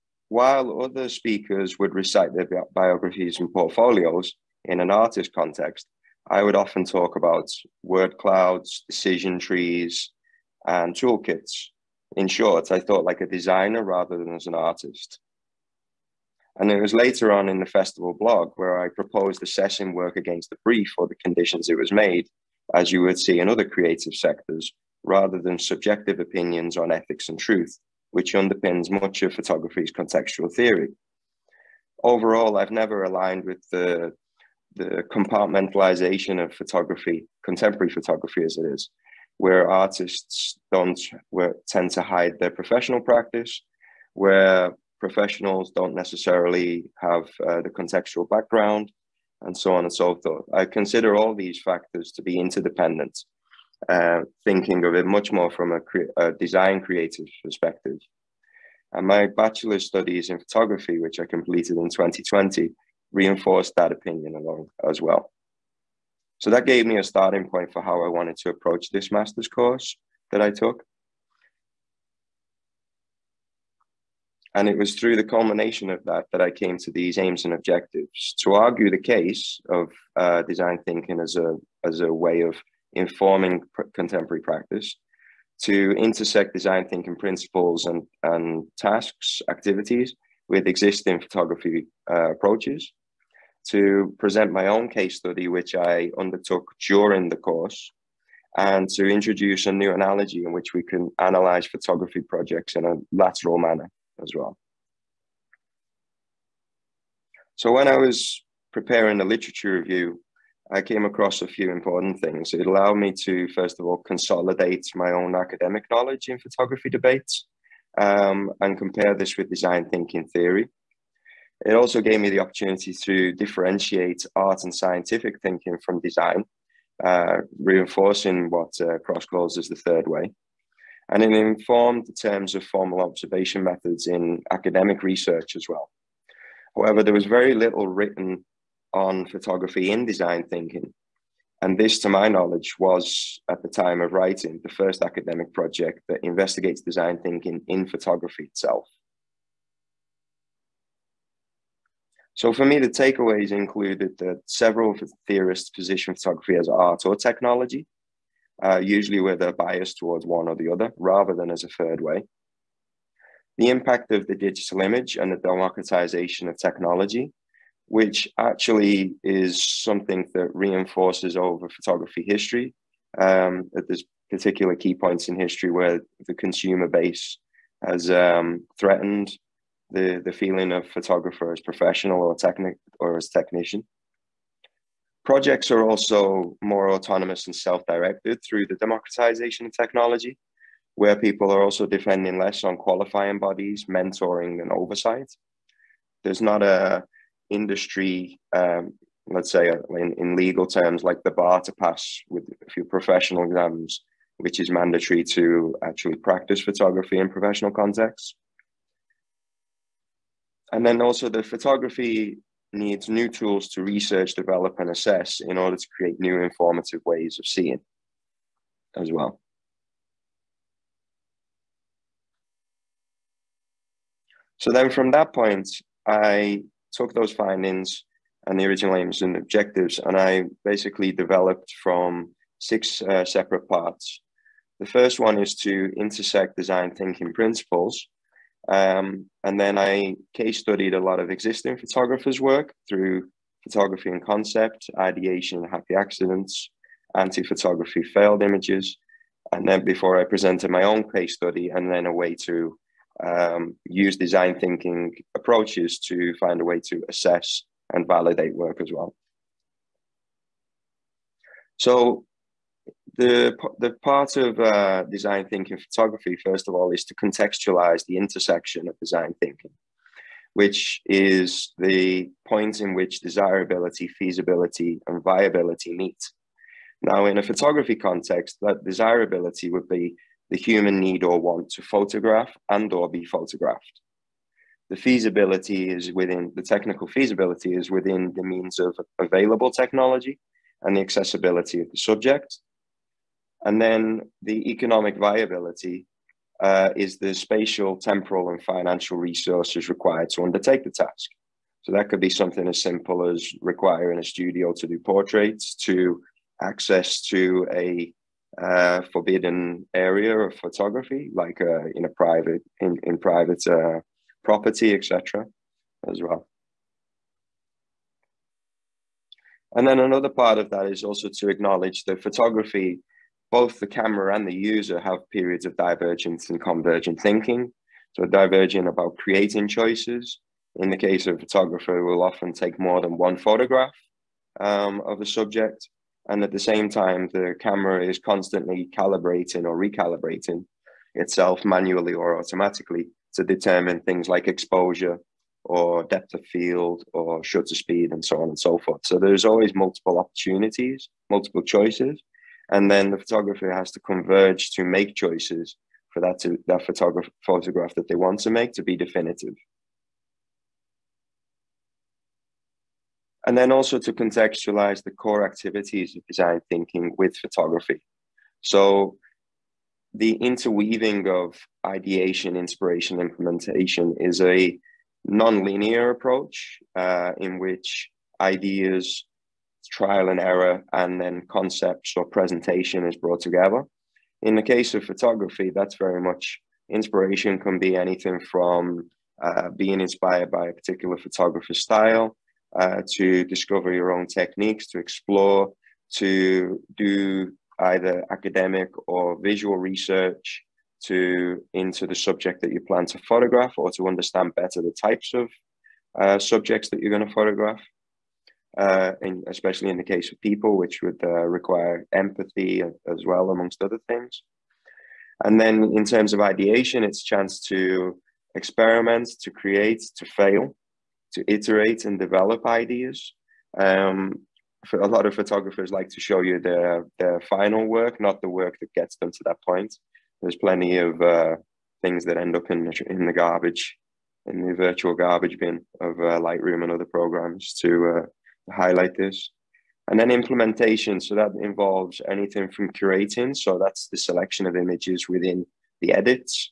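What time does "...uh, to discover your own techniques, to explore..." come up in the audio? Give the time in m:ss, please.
6:32.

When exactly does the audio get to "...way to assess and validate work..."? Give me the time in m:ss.
4:16.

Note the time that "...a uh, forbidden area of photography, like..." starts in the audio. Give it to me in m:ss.
5:07.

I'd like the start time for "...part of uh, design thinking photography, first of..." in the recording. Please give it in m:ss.
4:24.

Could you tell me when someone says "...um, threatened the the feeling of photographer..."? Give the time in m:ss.
2:58.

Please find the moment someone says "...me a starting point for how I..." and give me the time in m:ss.
1:06.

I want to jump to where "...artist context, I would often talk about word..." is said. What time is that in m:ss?
0:04.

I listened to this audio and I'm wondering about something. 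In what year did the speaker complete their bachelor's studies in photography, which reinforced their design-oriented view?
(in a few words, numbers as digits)
2020.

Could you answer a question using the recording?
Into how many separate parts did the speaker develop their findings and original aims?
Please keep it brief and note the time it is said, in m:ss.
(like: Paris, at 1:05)
6, at 3:52.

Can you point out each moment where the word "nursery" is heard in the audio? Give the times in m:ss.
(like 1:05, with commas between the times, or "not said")
not said.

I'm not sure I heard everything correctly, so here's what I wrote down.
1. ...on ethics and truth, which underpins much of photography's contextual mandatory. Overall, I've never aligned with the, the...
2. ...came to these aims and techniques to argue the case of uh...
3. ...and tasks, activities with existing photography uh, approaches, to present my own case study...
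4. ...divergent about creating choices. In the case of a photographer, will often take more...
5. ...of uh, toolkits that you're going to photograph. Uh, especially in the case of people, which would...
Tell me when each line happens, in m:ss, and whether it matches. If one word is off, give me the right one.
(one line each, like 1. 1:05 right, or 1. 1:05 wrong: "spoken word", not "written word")
1. 0:26 wrong: "theory", not "mandatory"
2. 1:16 wrong: "objectives", not "techniques"
3. 1:28 right
4. 5:28 right
5. 6:45 wrong: "subjects", not "toolkits".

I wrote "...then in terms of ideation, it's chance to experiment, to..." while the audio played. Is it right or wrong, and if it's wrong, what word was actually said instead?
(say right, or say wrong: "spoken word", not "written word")
right.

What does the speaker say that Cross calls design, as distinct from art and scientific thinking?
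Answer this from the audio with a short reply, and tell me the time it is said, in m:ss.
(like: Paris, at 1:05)
the third way, at 2:09.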